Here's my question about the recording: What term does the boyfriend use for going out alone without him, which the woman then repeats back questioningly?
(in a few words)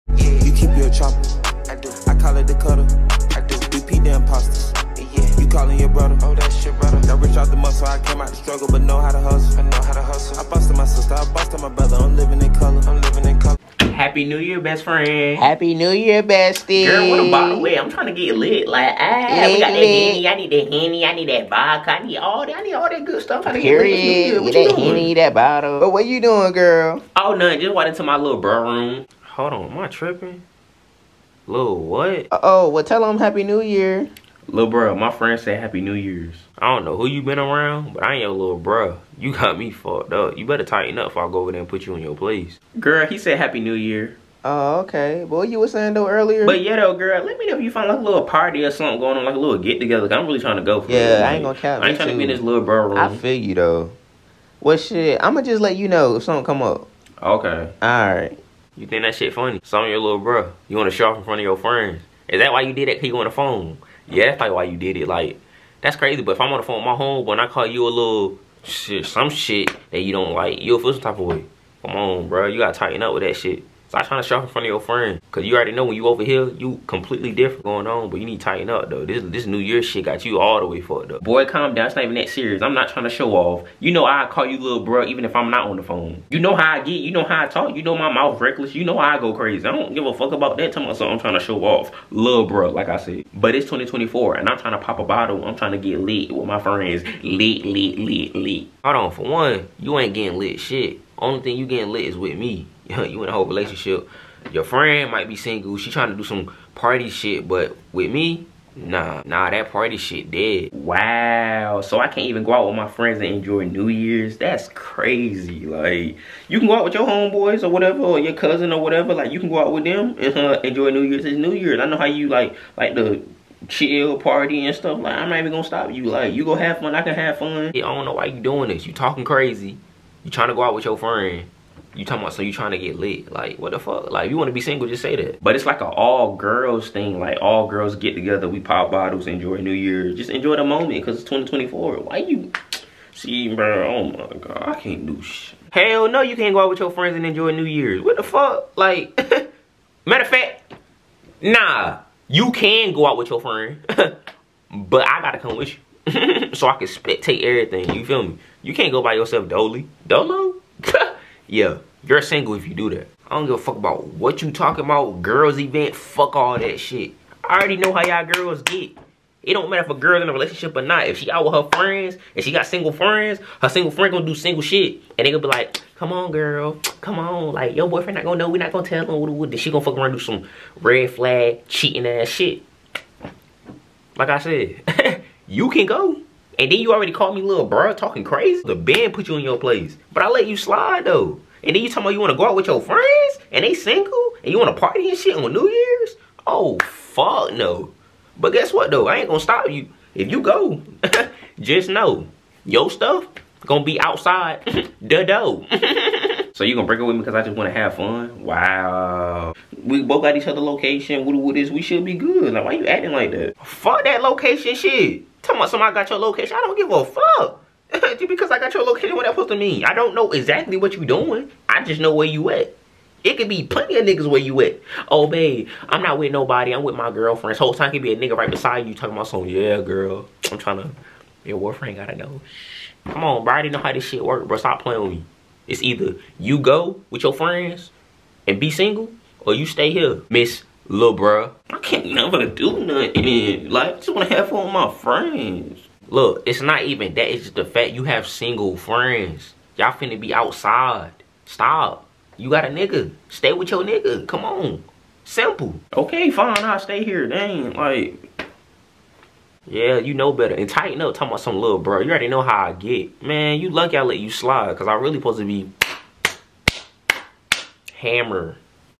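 Dolo.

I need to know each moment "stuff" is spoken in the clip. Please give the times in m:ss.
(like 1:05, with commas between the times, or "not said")
0:23, 2:04, 3:22.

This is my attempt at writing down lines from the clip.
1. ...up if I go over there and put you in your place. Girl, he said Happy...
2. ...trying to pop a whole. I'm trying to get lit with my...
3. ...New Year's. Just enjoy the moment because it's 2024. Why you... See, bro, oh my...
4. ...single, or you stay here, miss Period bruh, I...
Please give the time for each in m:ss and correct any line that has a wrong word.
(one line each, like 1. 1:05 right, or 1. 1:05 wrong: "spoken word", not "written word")
1. 0:40 right
2. 1:34 wrong: "bottle", not "whole"
3. 2:19 right
4. 3:58 wrong: "Little", not "Period".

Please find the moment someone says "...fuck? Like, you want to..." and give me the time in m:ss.
2:13.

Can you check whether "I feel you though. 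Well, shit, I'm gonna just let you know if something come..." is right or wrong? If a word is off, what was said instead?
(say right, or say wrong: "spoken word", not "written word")
right.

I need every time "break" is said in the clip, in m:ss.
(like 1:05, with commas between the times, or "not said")
3:26.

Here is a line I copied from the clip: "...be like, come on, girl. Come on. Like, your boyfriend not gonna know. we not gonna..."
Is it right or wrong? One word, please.
right.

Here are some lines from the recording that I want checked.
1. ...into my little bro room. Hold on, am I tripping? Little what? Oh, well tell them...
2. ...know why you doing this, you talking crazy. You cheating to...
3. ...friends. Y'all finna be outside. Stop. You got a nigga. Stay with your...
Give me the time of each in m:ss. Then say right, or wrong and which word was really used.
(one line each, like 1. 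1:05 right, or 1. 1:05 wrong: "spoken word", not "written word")
1. 0:27 right
2. 2:08 wrong: "trying", not "cheating"
3. 4:08 right.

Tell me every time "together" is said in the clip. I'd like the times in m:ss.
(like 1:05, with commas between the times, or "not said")
0:49, 2:18.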